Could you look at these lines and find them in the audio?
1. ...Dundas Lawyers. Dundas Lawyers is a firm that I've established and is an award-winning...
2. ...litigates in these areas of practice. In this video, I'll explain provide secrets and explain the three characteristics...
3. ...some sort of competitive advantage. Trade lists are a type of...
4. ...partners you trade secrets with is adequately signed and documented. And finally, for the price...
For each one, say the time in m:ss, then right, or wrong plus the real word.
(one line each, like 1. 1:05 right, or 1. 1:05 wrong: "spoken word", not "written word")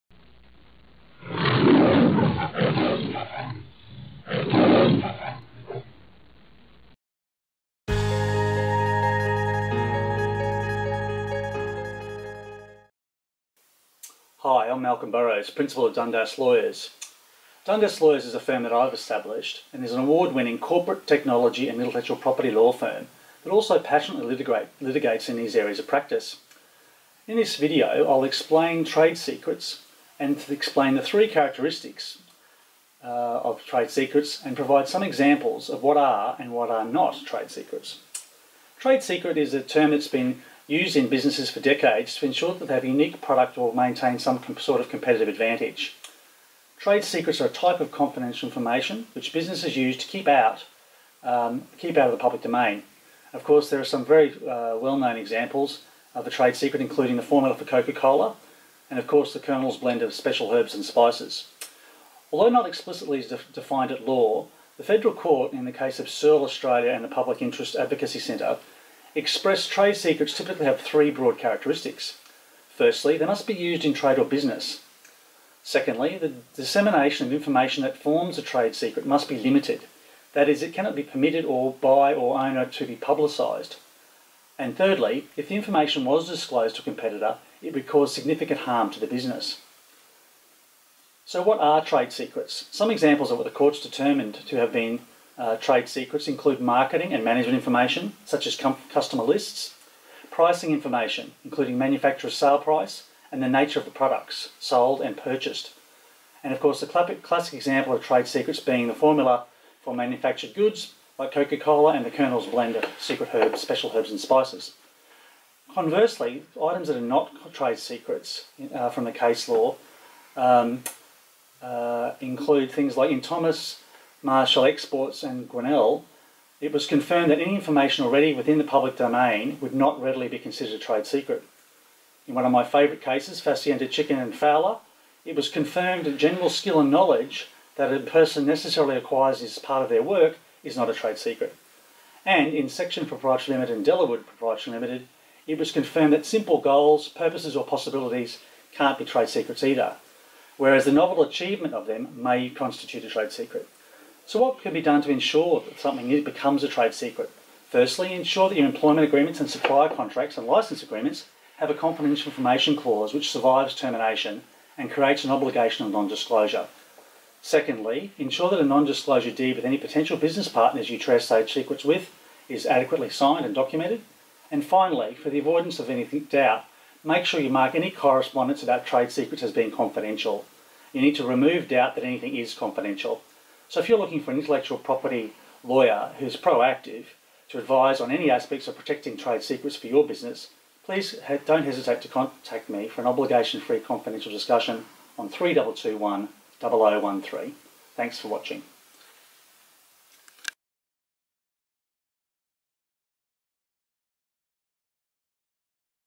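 1. 0:15 right
2. 0:24 wrong: "trade", not "provide"
3. 0:44 wrong: "secrets", not "lists"
4. 2:50 wrong: "avoidance", not "price".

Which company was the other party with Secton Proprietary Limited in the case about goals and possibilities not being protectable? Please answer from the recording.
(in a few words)
Delawood Proprietary Limited.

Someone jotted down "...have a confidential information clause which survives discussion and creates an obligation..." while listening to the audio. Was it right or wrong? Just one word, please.
wrong.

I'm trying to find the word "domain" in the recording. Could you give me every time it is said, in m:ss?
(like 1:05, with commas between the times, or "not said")
0:52, 2:08.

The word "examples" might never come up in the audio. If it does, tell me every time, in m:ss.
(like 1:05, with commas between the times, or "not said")
0:35, 0:55, 1:32, 1:47.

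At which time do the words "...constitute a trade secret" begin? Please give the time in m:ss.
2:32.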